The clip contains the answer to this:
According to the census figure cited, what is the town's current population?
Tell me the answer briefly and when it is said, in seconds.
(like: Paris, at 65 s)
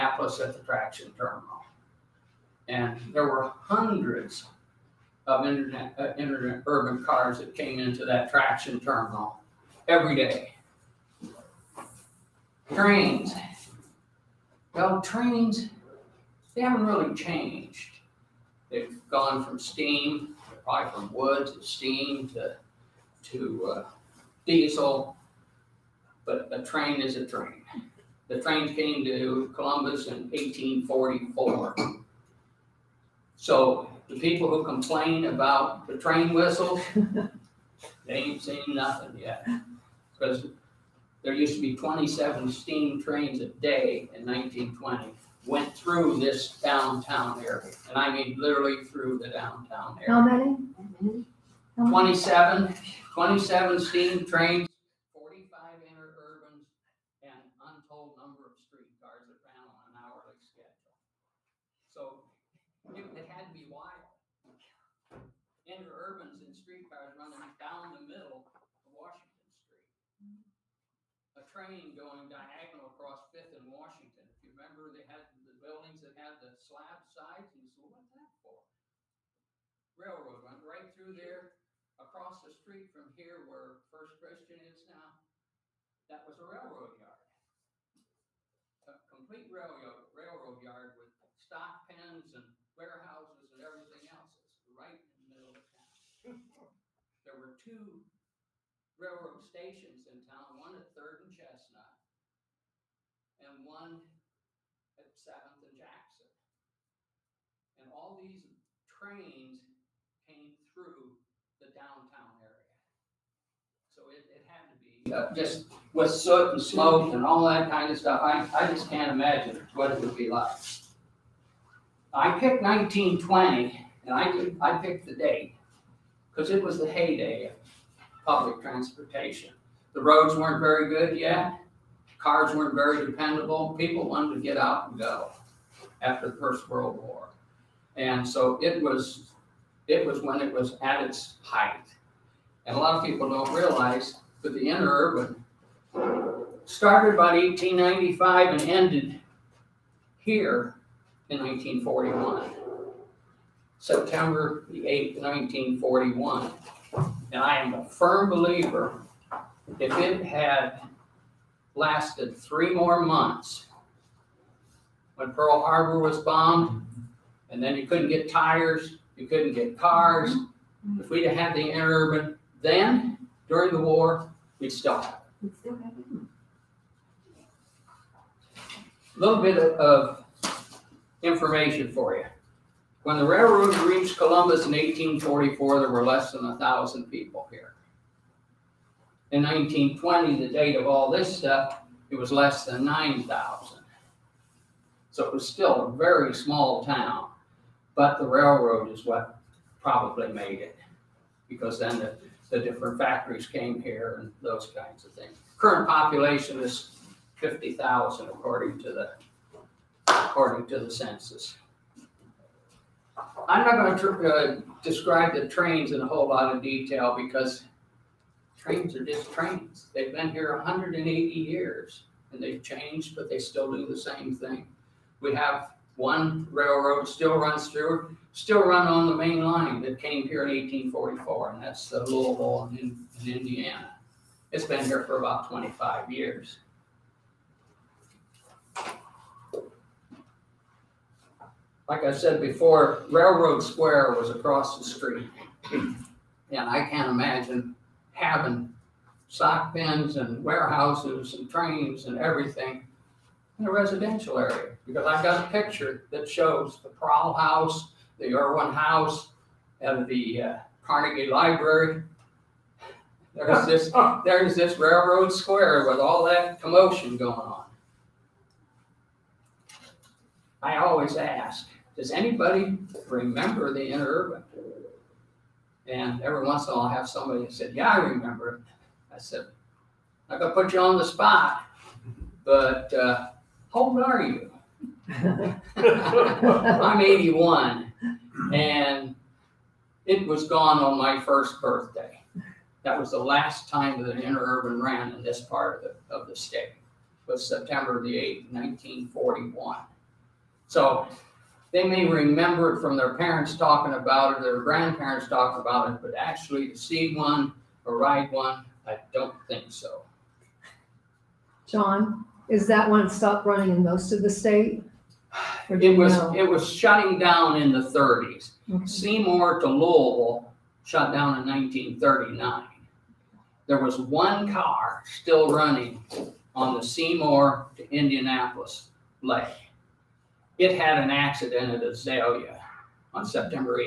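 50,000, at 207 s.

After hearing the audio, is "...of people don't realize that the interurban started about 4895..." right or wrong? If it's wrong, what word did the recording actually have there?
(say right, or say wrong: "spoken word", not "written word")
wrong: "1895", not "4895".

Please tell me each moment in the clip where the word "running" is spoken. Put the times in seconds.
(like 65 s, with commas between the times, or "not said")
67 s, 313 s, 325 s.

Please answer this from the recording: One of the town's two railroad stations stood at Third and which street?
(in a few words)
Chestnut.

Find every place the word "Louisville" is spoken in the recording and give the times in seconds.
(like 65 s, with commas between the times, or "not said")
232 s, 319 s.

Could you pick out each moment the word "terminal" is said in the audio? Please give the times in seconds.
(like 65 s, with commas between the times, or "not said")
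1 s, 8 s.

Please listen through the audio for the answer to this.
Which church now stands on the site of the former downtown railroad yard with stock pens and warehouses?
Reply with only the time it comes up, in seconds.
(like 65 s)
83 s.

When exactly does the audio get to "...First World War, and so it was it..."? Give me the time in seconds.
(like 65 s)
136 s.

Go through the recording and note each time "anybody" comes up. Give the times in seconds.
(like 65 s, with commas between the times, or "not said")
272 s.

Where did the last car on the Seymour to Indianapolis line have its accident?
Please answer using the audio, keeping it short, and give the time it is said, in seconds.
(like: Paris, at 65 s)
Azalia, at 331 s.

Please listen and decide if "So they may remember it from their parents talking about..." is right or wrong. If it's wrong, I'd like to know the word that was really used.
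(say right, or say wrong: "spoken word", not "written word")
right.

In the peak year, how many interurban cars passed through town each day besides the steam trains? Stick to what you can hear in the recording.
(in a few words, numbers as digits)
45.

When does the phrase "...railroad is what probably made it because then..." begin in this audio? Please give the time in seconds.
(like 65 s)
198 s.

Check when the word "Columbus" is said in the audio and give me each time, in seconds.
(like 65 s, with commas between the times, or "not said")
29 s, 184 s.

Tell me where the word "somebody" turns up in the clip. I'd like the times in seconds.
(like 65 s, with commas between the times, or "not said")
277 s.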